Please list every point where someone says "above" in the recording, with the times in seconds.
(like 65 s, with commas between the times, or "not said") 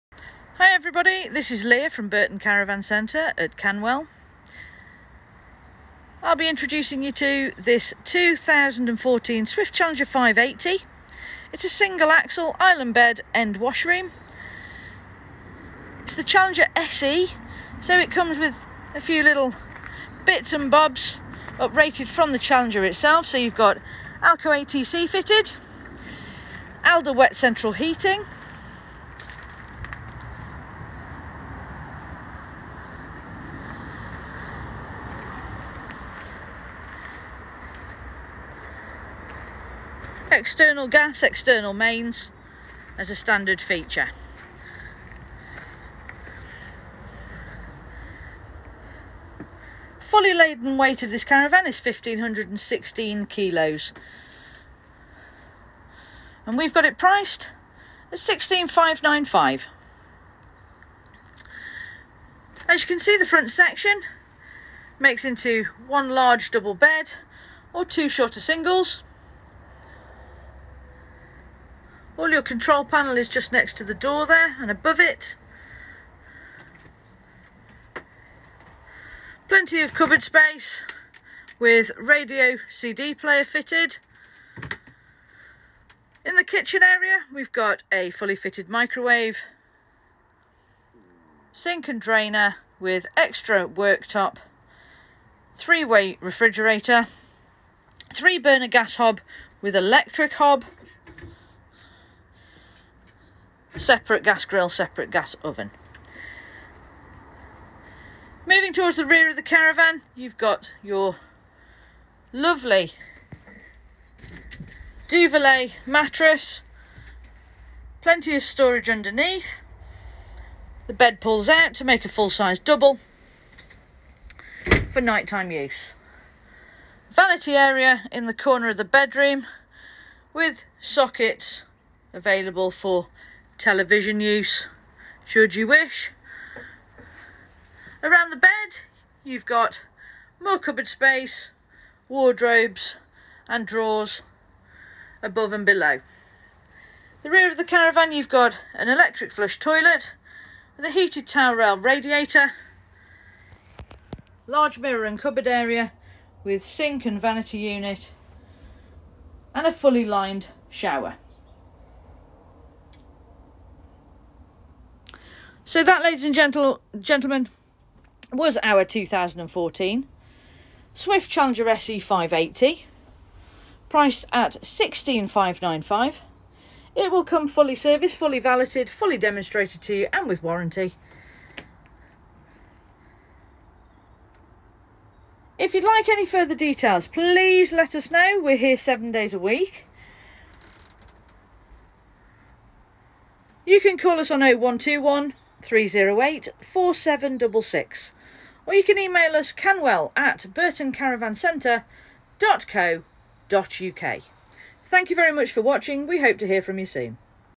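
74 s, 145 s.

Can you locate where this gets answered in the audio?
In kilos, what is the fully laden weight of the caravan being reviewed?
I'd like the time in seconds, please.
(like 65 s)
51 s.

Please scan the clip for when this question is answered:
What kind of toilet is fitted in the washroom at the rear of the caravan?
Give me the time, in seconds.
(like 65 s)
148 s.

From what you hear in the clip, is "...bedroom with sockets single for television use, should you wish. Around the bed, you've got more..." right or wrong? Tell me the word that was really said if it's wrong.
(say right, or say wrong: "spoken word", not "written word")
wrong: "available", not "single".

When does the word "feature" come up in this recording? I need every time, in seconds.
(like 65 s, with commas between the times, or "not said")
43 s.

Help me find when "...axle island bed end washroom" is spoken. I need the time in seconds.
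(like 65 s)
12 s.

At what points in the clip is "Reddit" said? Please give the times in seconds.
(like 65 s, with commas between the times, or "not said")
not said.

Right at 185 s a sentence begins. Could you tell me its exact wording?
If you'd like any further details, please let us know.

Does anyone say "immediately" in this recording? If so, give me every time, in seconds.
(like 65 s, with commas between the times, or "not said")
not said.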